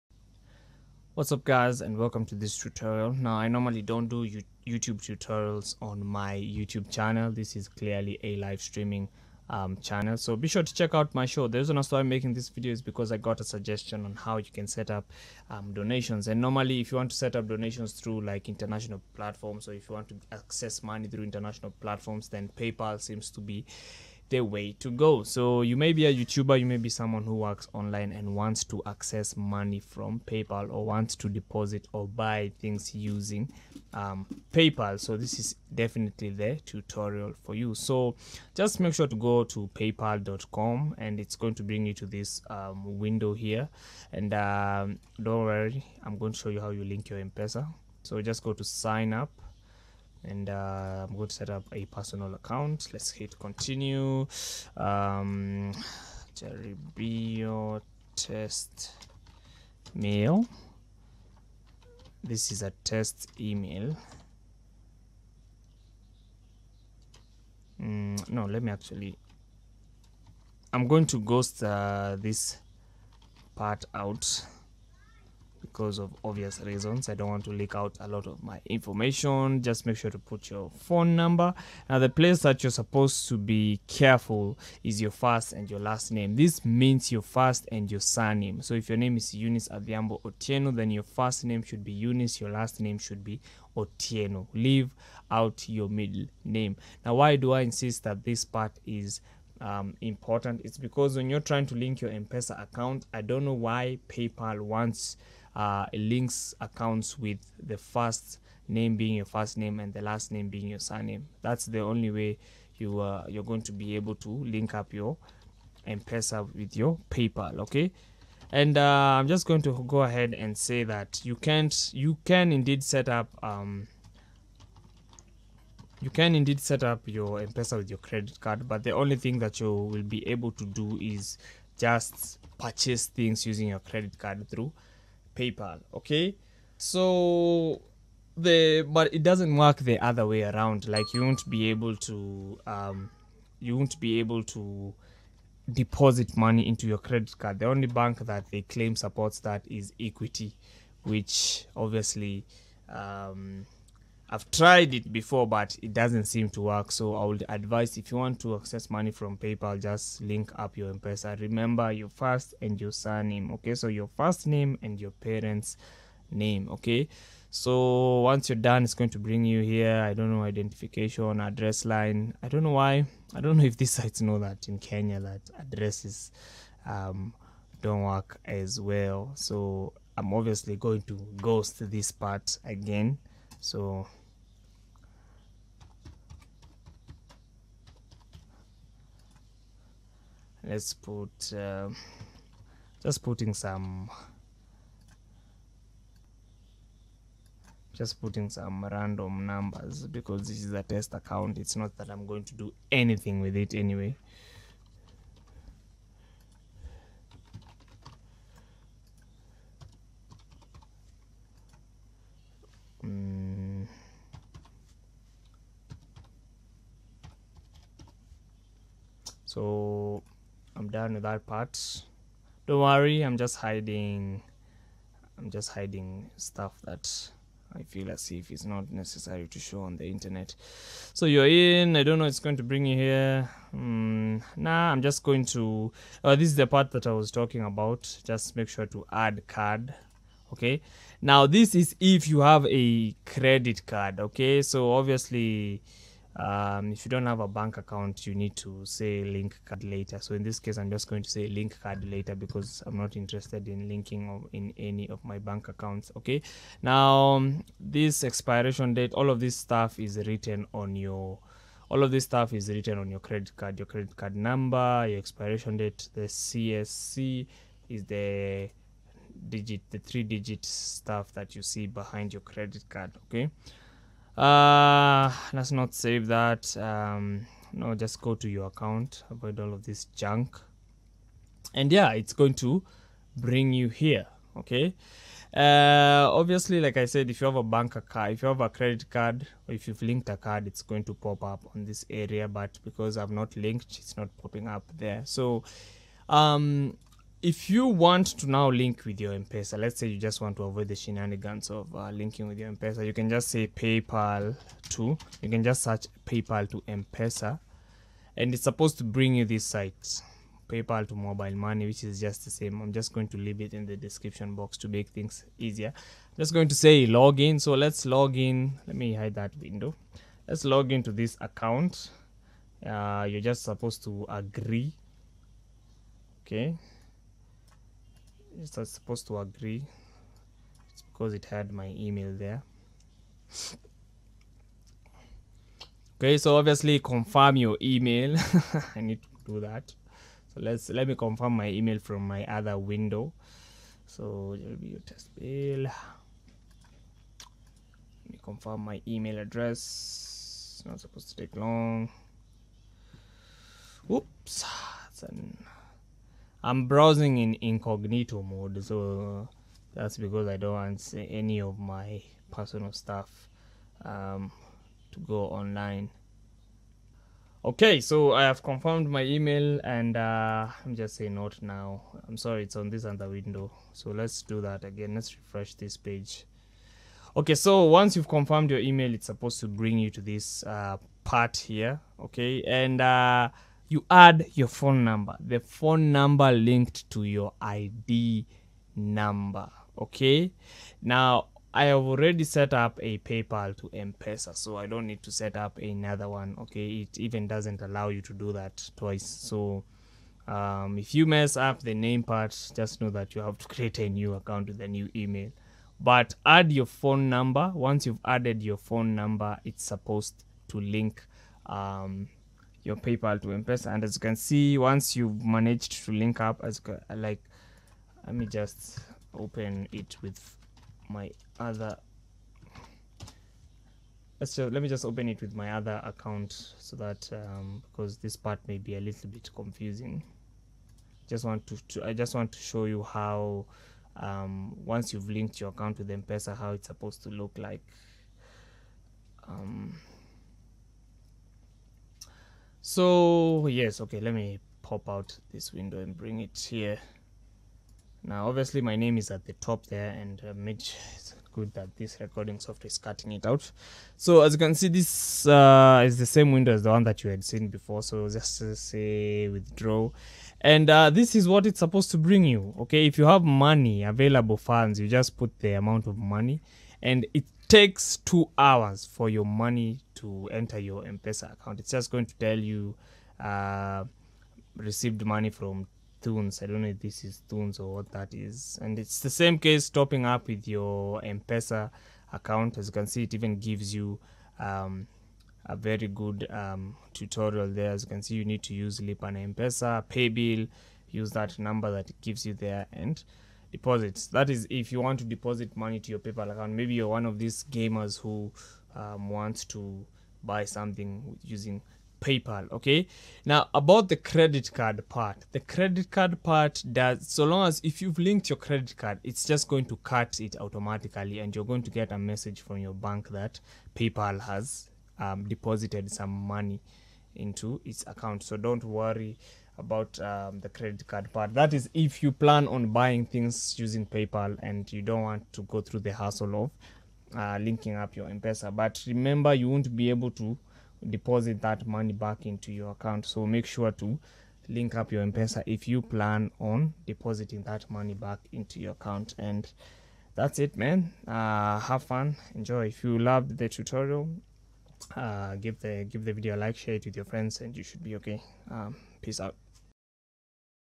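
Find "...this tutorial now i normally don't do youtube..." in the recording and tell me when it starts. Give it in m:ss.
0:02.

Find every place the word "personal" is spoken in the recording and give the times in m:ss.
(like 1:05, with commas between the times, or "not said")
0:51, 6:02.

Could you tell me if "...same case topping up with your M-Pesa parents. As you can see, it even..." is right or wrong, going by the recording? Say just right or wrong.
wrong.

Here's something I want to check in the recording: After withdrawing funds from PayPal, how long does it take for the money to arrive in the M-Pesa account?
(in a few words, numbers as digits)
2 hours.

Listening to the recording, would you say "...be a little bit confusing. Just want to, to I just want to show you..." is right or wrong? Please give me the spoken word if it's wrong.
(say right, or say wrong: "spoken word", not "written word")
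right.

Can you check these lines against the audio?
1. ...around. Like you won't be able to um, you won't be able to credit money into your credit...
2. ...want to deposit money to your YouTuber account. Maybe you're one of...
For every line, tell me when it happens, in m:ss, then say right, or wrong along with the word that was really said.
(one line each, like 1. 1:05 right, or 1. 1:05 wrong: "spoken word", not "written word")
1. 2:20 wrong: "deposit", not "credit"
2. 8:15 wrong: "PayPal", not "YouTuber".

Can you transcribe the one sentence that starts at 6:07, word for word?
Okay, so I have confirmed my email and uh, I'm just saying not now.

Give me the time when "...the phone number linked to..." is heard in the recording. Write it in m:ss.
6:25.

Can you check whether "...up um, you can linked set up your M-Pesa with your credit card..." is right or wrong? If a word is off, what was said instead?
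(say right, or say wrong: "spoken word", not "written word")
wrong: "indeed", not "linked".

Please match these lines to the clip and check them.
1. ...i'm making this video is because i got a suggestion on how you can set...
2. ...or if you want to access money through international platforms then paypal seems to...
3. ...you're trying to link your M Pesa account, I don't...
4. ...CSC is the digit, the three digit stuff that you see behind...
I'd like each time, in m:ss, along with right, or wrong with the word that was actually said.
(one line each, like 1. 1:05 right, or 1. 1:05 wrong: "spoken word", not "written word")
1. 0:11 right
2. 0:19 right
3. 1:41 right
4. 4:26 right.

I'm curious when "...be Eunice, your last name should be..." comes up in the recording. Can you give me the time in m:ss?
1:31.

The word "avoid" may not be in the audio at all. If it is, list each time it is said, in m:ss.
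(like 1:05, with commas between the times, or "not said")
4:39, 5:00.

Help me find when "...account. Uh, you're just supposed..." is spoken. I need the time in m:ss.
5:21.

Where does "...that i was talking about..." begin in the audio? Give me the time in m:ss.
3:56.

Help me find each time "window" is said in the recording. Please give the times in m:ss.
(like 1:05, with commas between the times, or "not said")
0:42, 5:19, 5:42, 6:13, 7:25, 7:36.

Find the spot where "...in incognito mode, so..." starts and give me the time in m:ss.
5:57.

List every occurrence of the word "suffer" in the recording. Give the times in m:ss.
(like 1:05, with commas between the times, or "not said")
not said.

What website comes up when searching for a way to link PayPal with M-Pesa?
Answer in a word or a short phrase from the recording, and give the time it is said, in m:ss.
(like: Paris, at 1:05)
PayPal to Mobile Money, at 5:10.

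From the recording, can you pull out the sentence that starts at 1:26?
This means your first and your surname.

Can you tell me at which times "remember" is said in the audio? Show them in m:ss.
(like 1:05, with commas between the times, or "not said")
2:41, 8:49.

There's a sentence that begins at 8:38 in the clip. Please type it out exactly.
So don't worry about um, the credit card part.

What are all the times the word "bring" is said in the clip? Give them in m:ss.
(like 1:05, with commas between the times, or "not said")
0:41, 2:49, 3:52, 4:43, 5:09, 6:19, 7:26, 7:42.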